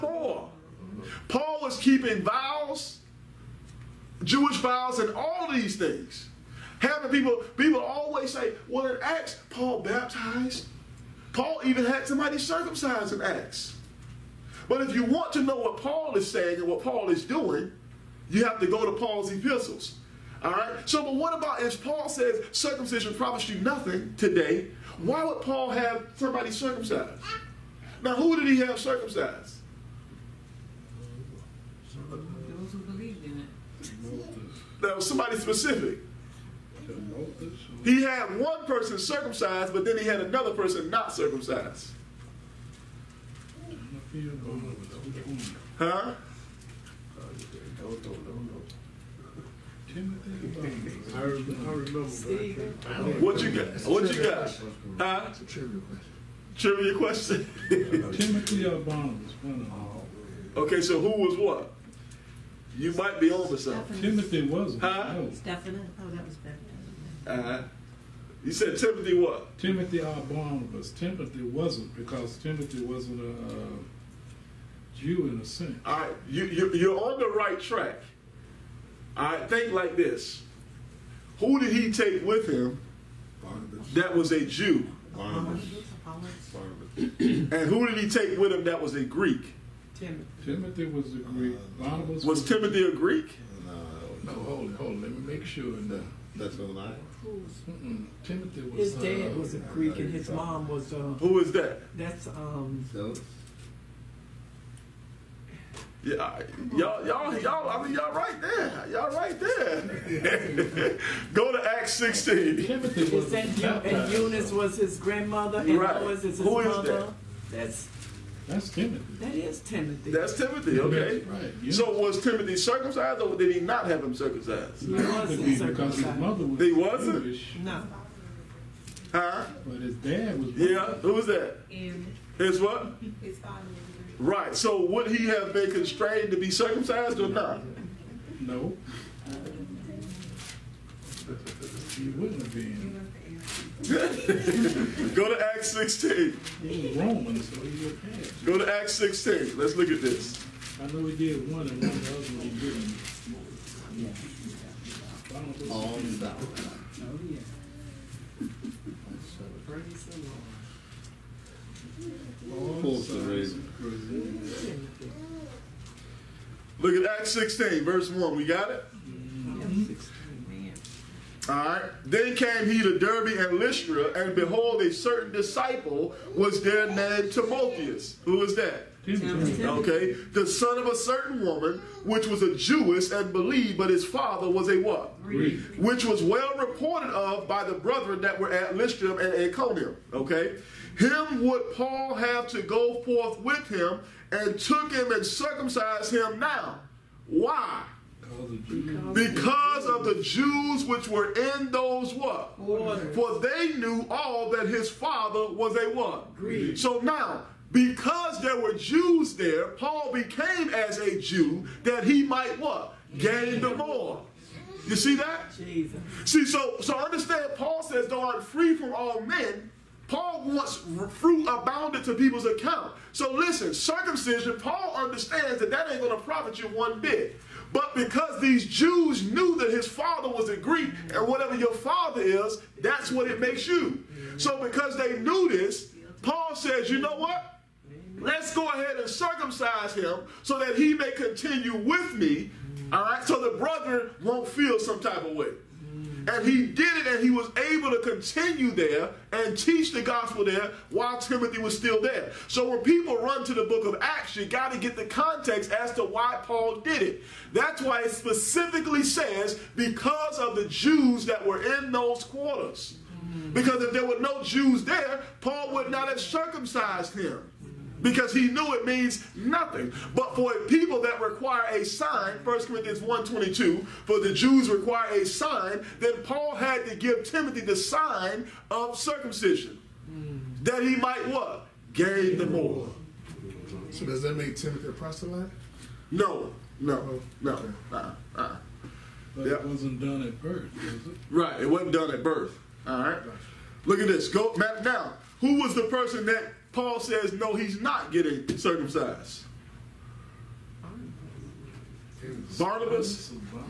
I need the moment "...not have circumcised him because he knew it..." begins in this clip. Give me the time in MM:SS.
04:25.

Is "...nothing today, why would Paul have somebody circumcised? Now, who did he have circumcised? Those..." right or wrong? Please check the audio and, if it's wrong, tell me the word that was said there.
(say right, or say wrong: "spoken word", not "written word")
right.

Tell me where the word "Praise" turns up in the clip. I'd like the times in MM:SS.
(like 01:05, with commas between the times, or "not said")
02:39.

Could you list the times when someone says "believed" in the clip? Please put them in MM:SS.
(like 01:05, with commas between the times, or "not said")
00:32, 03:03.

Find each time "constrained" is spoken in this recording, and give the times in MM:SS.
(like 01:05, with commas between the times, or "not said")
02:15.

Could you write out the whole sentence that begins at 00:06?
Having people, people always say, well, in Acts, Paul baptized.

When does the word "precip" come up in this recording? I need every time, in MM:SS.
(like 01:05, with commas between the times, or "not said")
not said.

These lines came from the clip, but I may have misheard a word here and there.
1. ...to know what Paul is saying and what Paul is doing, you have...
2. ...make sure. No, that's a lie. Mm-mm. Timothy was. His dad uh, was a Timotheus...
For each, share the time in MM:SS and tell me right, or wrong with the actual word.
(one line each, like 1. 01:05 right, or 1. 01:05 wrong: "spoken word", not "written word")
1. 00:15 right
2. 01:35 wrong: "Greek", not "Timotheus".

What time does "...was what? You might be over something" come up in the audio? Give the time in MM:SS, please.
01:01.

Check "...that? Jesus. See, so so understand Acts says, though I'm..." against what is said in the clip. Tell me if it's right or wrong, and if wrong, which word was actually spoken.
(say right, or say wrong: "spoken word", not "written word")
wrong: "Paul", not "Acts".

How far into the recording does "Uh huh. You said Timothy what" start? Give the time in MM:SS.
01:07.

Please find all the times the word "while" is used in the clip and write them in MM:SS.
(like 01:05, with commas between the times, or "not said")
04:10.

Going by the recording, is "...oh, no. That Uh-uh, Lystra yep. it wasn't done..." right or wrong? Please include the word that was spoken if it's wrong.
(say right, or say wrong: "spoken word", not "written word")
wrong: "But", not "Lystra".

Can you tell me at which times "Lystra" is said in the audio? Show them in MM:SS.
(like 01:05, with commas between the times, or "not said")
02:53, 03:08.